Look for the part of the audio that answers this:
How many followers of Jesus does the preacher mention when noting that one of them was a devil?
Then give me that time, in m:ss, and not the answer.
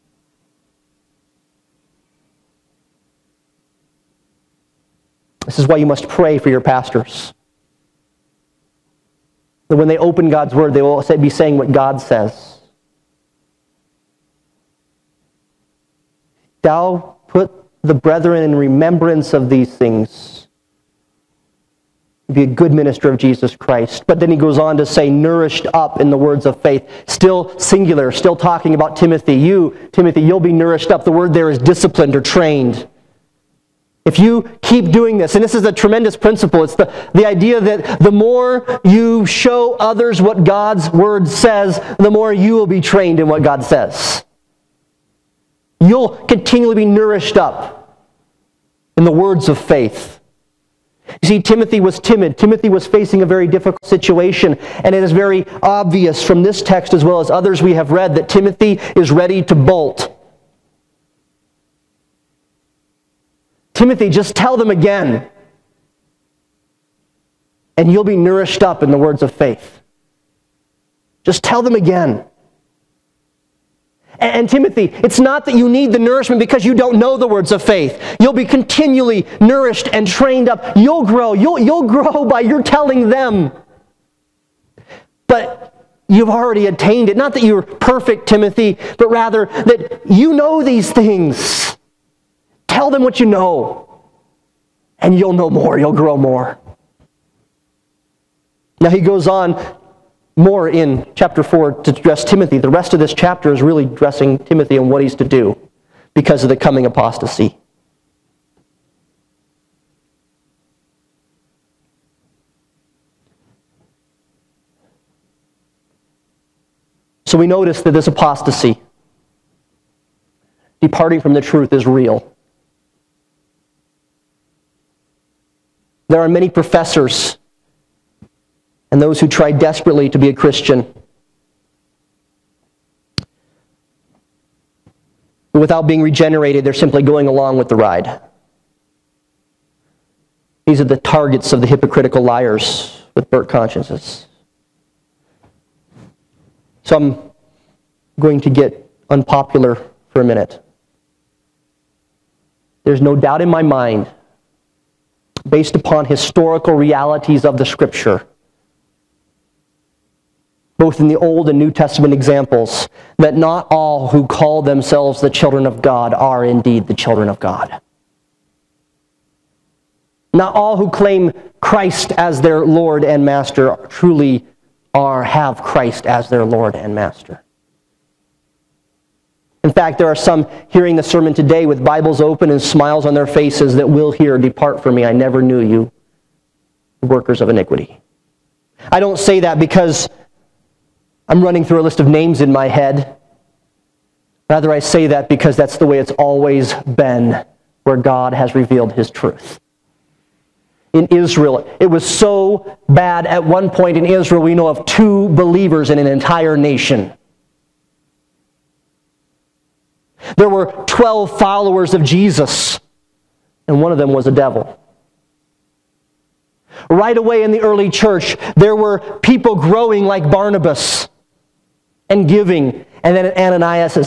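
3:30.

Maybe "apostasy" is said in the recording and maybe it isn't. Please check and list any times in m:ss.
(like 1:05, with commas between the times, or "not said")
1:46, 1:58.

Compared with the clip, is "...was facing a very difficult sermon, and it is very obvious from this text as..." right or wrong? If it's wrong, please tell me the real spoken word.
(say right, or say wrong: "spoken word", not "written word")
wrong: "situation", not "sermon".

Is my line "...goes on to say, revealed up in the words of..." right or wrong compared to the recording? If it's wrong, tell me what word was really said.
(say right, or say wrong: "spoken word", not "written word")
wrong: "nourished", not "revealed".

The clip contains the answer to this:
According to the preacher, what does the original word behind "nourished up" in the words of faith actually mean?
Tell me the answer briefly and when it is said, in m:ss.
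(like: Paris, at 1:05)
Disciplined or trained, at 0:31.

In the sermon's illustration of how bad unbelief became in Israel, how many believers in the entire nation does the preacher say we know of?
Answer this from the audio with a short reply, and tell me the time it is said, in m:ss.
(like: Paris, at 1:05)
2, at 3:24.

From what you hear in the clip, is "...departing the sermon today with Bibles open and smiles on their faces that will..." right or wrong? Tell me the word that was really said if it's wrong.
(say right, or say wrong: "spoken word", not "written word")
wrong: "hearing", not "departing".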